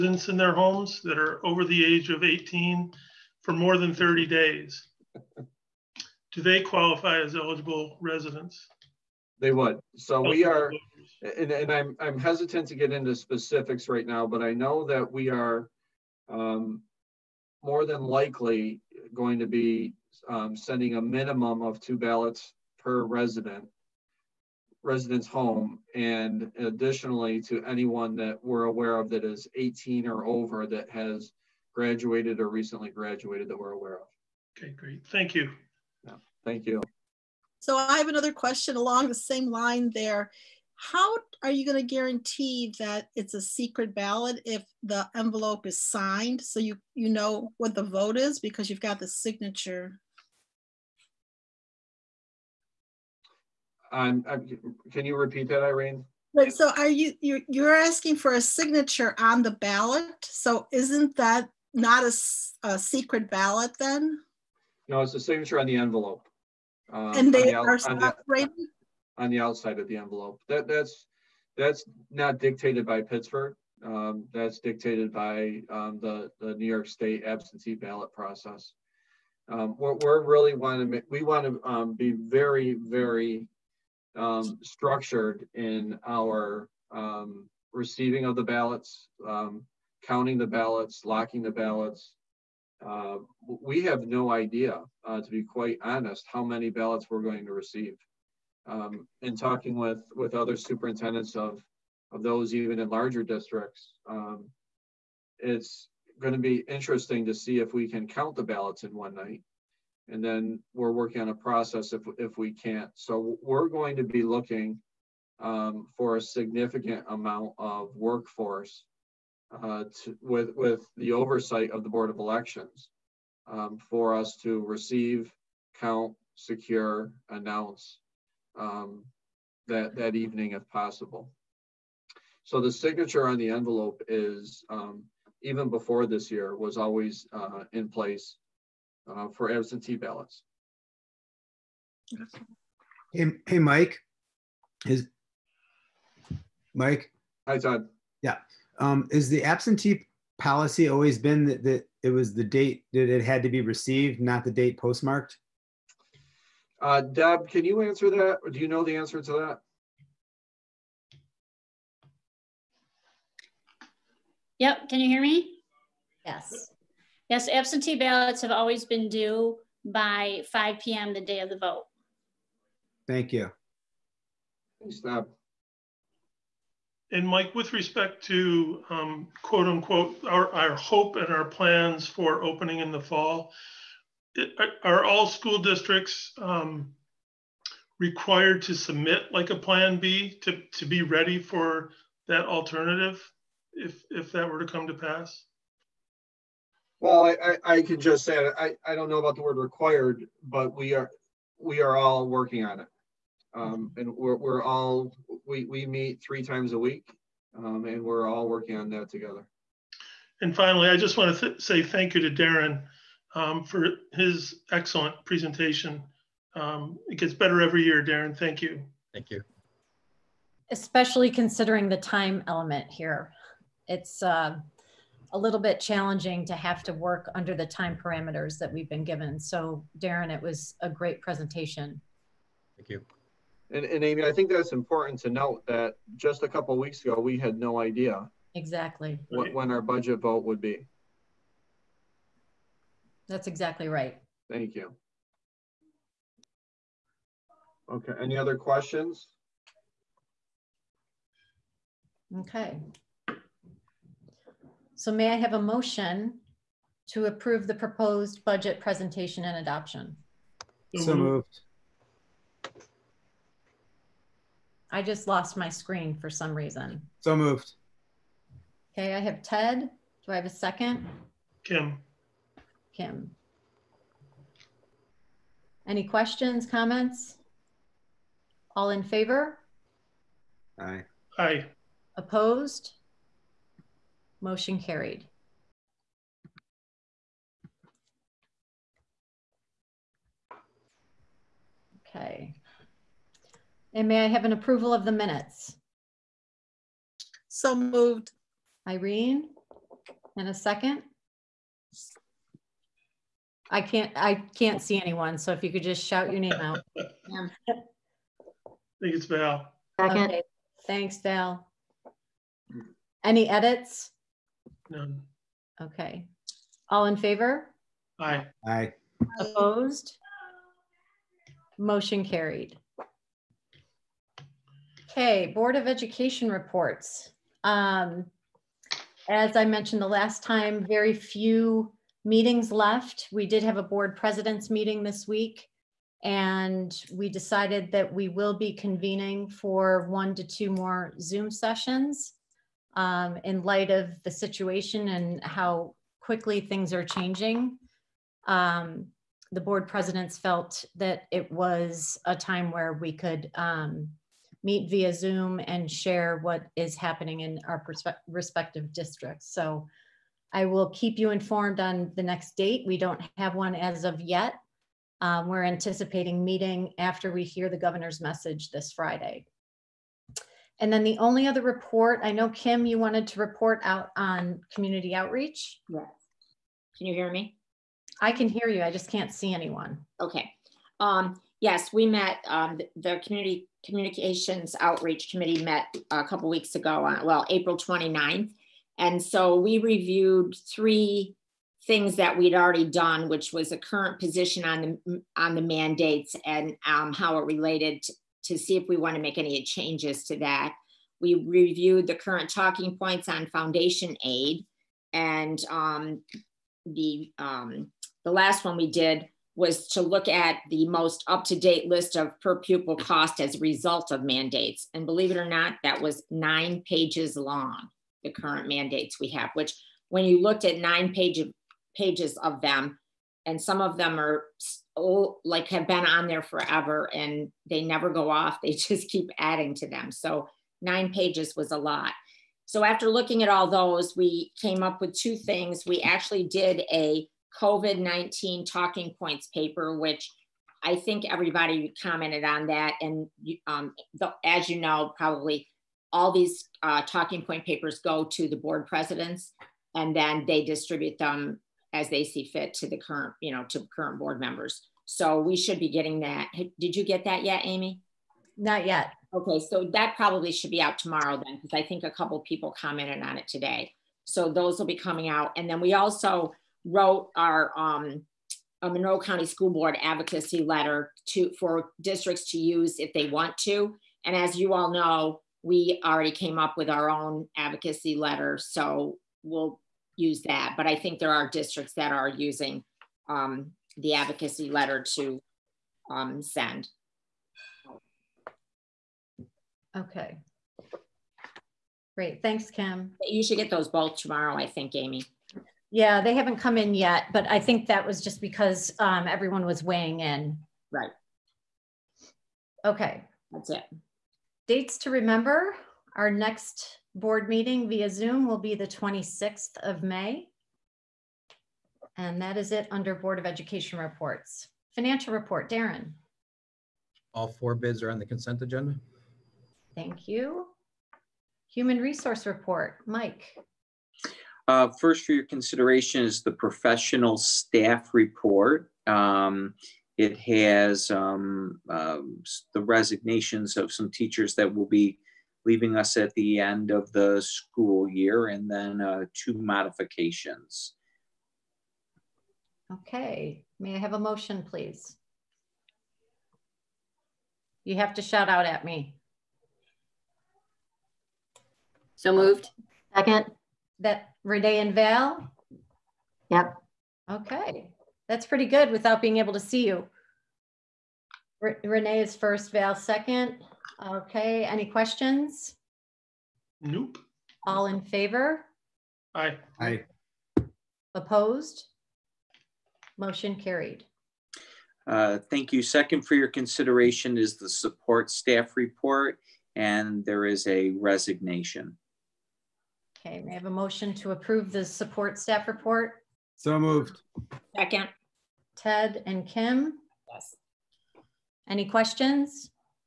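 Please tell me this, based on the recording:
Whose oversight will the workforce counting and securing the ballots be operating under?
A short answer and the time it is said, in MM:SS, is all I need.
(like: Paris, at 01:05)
Board of Elections, at 02:01.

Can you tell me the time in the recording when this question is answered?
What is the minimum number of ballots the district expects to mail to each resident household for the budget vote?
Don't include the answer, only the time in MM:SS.
00:21.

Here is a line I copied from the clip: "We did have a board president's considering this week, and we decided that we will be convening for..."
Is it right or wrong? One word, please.
wrong.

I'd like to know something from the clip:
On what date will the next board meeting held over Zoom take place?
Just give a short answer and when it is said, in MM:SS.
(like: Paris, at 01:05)
May 26, at 08:28.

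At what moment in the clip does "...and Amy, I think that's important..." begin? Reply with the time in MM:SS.
03:53.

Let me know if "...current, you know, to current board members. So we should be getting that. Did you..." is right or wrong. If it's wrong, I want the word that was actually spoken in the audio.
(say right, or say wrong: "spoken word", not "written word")
right.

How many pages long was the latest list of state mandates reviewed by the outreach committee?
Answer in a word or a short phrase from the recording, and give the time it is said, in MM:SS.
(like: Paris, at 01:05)
9, at 06:56.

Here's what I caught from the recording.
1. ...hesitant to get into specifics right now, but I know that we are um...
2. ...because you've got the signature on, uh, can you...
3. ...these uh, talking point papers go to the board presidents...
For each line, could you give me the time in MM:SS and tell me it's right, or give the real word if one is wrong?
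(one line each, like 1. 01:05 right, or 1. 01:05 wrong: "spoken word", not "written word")
1. 00:12 right
2. 00:48 right
3. 07:26 right.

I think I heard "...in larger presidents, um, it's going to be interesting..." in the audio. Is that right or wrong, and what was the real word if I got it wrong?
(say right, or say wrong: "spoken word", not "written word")
wrong: "districts", not "presidents".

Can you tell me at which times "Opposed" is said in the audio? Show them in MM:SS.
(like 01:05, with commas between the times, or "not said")
04:42, 05:19, 09:31.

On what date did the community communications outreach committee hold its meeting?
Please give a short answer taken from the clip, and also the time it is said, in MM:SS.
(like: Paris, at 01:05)
April 29th, at 06:27.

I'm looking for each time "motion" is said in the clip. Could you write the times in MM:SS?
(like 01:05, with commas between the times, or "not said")
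04:15, 04:44, 05:21, 09:04, 09:33, 09:43.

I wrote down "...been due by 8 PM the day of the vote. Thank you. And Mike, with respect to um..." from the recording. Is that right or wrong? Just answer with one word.
wrong.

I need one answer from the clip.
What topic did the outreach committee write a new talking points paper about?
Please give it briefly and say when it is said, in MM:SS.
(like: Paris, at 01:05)
COVID-19, at 07:17.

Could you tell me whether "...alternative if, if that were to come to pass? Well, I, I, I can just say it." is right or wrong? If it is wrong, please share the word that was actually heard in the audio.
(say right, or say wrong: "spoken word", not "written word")
right.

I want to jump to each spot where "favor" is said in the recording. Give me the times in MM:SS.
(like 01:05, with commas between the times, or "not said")
04:39, 05:17, 09:28.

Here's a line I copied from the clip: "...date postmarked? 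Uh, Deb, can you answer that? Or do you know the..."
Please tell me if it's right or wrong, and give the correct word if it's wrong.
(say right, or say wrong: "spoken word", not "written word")
right.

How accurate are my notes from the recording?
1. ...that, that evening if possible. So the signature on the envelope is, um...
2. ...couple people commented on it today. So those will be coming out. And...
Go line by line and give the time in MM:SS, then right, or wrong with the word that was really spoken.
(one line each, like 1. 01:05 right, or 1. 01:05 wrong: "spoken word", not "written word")
1. 02:09 right
2. 07:42 right.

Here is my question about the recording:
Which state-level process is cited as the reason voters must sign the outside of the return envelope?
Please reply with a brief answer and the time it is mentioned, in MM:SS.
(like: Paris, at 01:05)
New York State absentee ballot process, at 01:16.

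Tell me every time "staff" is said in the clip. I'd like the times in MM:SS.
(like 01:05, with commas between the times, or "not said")
08:47, 09:38, 09:45.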